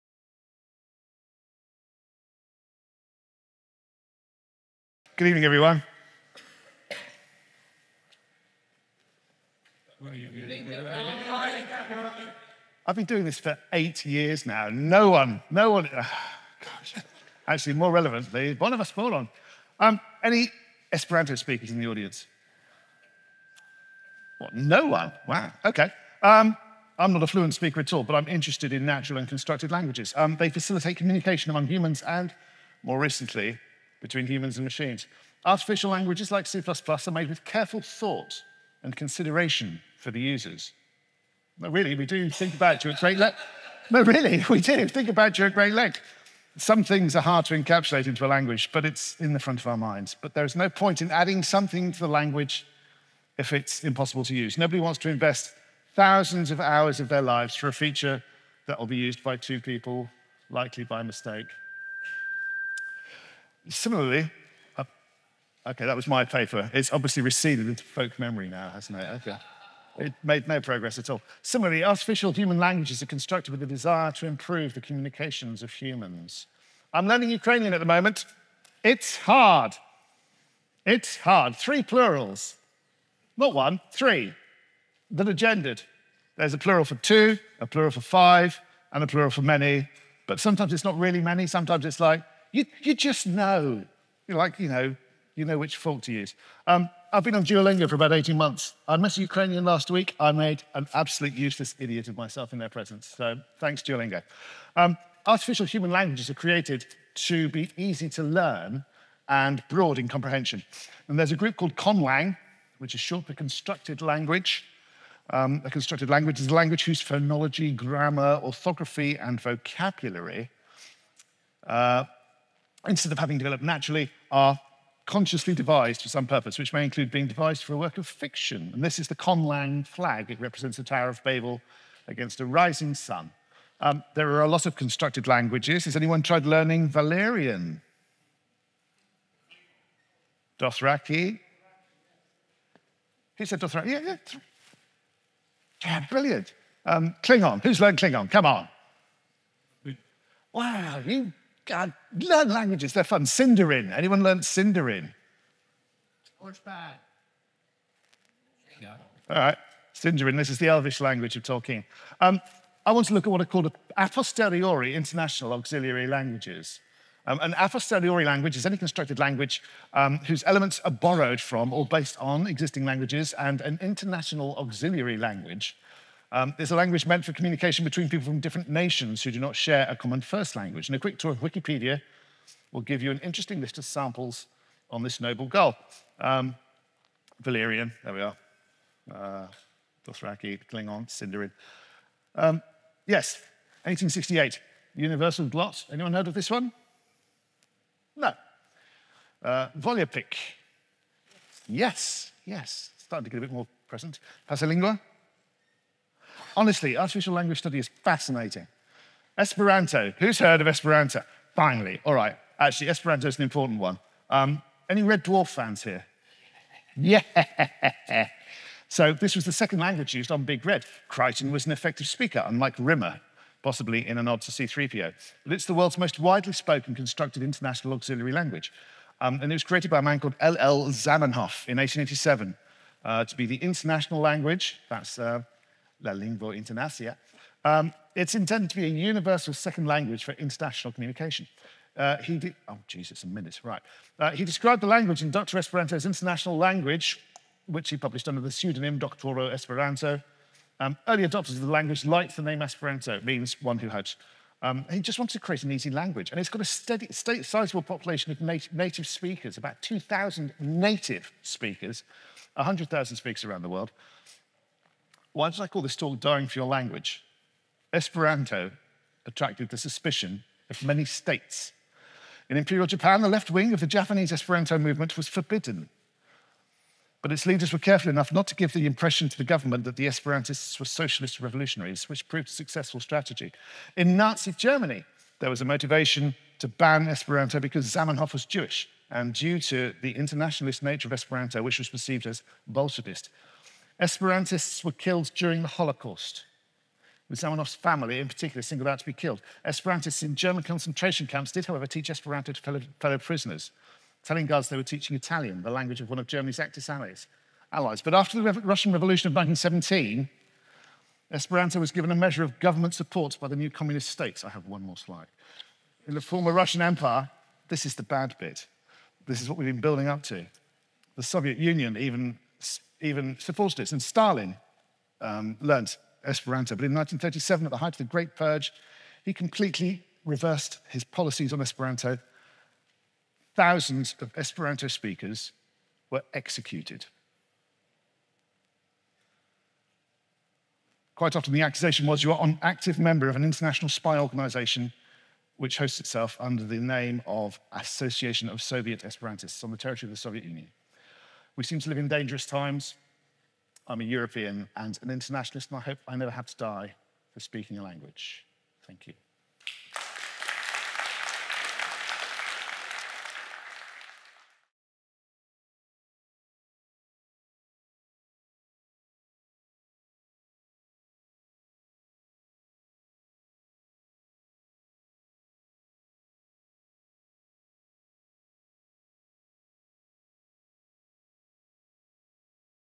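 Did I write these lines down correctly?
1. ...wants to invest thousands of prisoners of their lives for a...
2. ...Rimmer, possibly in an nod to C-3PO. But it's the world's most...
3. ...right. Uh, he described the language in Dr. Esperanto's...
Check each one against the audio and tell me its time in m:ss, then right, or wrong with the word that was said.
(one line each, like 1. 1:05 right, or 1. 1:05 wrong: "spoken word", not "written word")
1. 0:54 wrong: "hours", not "prisoners"
2. 3:42 right
3. 4:03 right.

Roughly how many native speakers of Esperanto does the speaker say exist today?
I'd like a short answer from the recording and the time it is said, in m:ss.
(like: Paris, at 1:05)
2,000, at 4:19.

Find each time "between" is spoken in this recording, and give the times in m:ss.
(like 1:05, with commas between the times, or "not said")
0:34, 2:57.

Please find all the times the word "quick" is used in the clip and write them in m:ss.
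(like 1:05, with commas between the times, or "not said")
3:00.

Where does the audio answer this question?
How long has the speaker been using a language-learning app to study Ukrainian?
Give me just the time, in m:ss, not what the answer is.
1:37.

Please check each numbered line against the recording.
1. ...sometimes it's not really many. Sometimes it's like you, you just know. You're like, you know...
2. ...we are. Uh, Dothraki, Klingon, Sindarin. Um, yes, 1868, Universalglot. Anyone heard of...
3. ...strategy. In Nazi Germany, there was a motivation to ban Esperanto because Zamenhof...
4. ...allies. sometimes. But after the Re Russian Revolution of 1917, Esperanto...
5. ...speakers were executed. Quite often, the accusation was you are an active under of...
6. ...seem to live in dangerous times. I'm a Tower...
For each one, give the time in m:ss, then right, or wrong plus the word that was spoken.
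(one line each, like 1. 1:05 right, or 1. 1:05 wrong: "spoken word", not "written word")
1. 1:30 right
2. 3:08 right
3. 4:42 right
4. 5:06 wrong: "allies", not "sometimes"
5. 5:34 wrong: "member", not "under"
6. 5:51 wrong: "European", not "Tower".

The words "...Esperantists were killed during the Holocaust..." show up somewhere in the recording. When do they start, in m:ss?
4:54.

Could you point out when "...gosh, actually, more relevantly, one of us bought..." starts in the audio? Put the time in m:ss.
0:16.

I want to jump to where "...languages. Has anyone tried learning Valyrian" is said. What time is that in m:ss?
2:15.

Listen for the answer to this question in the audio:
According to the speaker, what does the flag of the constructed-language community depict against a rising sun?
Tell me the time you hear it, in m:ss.
2:10.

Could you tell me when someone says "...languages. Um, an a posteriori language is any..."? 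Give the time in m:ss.
2:46.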